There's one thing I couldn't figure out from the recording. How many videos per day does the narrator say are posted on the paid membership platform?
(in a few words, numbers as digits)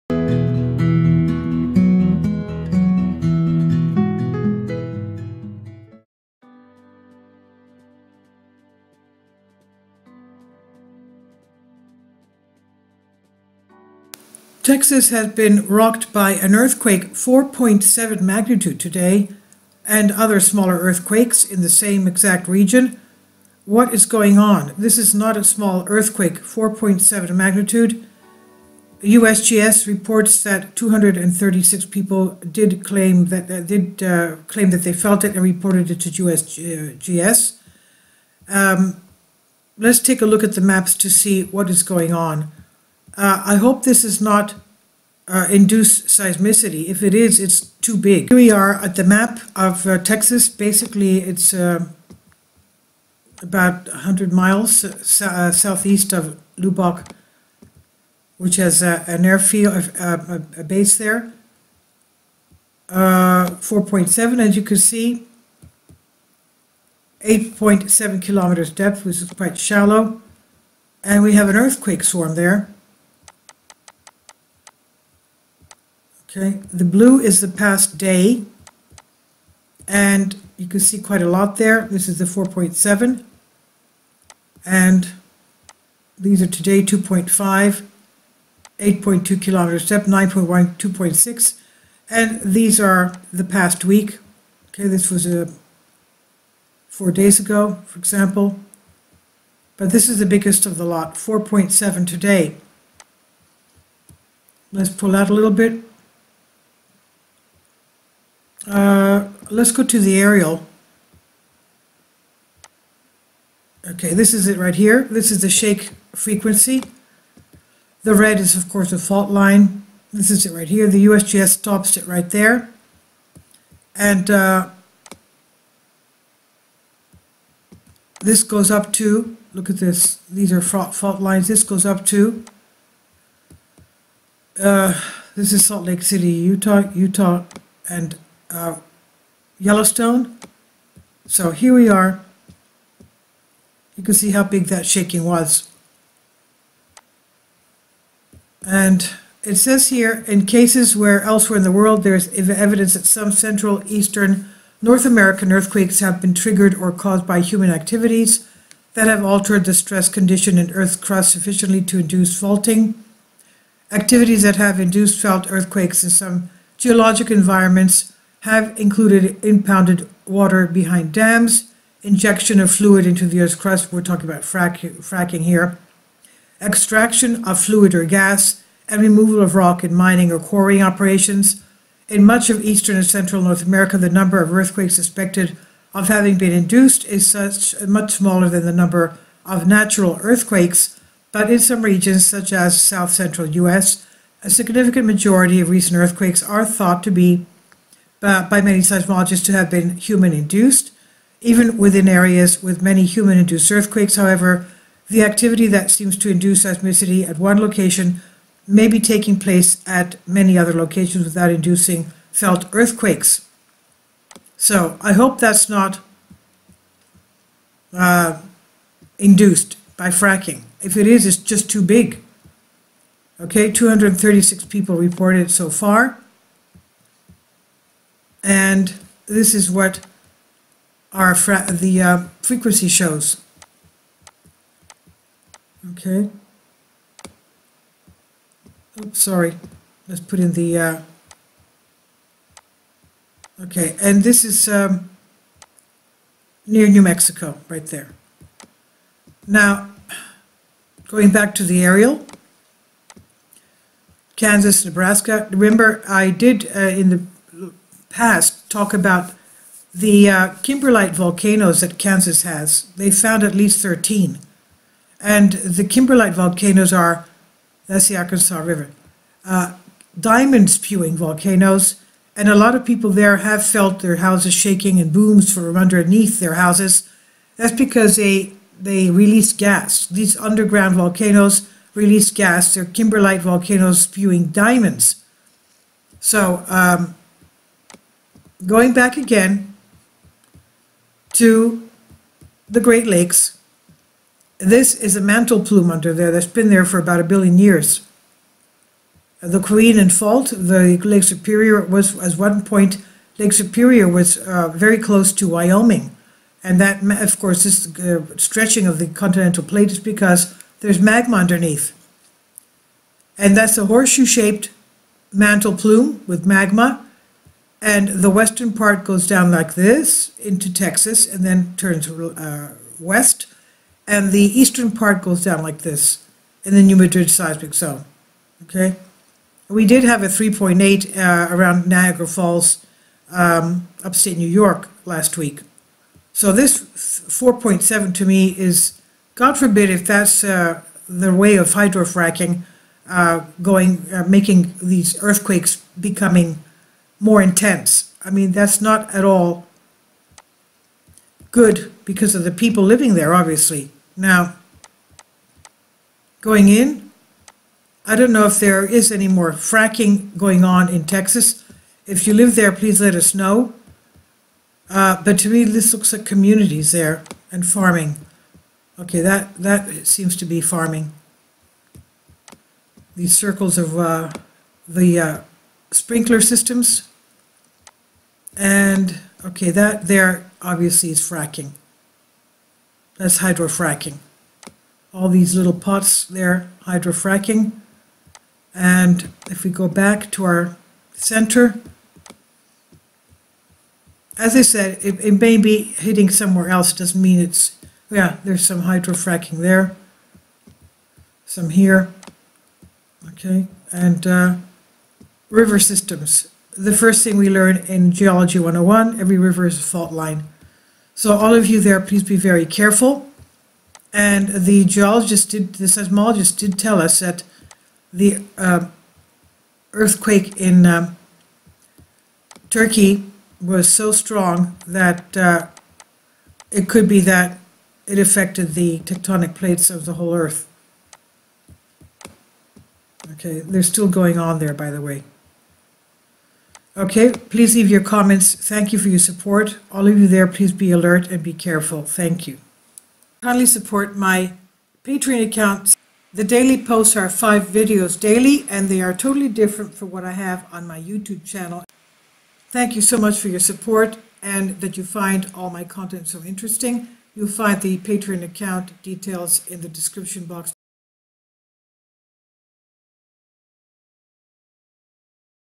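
5.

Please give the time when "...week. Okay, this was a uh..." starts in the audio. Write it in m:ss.
1:33.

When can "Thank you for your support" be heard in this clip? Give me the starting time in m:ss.
7:18.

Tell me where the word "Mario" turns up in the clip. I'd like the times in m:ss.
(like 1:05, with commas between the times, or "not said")
not said.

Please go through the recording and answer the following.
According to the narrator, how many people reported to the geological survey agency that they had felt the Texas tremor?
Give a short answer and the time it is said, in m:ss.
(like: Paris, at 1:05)
236, at 0:30.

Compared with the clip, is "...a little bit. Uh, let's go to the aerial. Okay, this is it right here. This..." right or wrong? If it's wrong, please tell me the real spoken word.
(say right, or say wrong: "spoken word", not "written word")
right.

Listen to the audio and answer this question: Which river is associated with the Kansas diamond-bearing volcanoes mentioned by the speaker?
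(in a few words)
Arkansas River.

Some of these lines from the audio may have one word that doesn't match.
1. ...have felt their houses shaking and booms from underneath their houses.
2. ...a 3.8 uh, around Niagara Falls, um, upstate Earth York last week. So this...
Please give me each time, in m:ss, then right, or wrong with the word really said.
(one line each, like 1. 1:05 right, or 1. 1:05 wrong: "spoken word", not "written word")
1. 4:33 right
2. 5:30 wrong: "New", not "Earth".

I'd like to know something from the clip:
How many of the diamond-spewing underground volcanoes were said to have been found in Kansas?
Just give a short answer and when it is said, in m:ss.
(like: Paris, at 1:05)
13, at 4:23.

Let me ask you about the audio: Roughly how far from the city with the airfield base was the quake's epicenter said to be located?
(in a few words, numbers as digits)
100 miles.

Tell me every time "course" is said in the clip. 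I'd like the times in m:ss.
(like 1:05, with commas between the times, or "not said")
1:58, 5:07.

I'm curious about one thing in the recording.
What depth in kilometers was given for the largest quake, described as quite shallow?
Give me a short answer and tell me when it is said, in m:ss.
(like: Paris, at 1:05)
8.7 kilometers, at 1:07.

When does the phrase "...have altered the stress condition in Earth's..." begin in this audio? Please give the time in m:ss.
2:39.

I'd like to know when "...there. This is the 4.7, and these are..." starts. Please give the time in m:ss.
1:21.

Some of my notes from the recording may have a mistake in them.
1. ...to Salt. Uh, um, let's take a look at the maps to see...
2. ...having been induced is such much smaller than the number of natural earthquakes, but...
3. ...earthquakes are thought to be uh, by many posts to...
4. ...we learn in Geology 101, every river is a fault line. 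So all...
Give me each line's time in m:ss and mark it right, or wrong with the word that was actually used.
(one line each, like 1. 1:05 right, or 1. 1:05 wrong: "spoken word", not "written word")
1. 0:36 wrong: "USGS", not "Salt"
2. 3:06 right
3. 3:15 wrong: "seismologists", not "posts"
4. 6:47 right.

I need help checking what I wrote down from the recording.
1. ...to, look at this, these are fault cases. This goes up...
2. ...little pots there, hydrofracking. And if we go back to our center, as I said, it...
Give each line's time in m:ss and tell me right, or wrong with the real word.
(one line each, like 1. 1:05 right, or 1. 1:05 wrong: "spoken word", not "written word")
1. 2:08 wrong: "lines", not "cases"
2. 6:25 right.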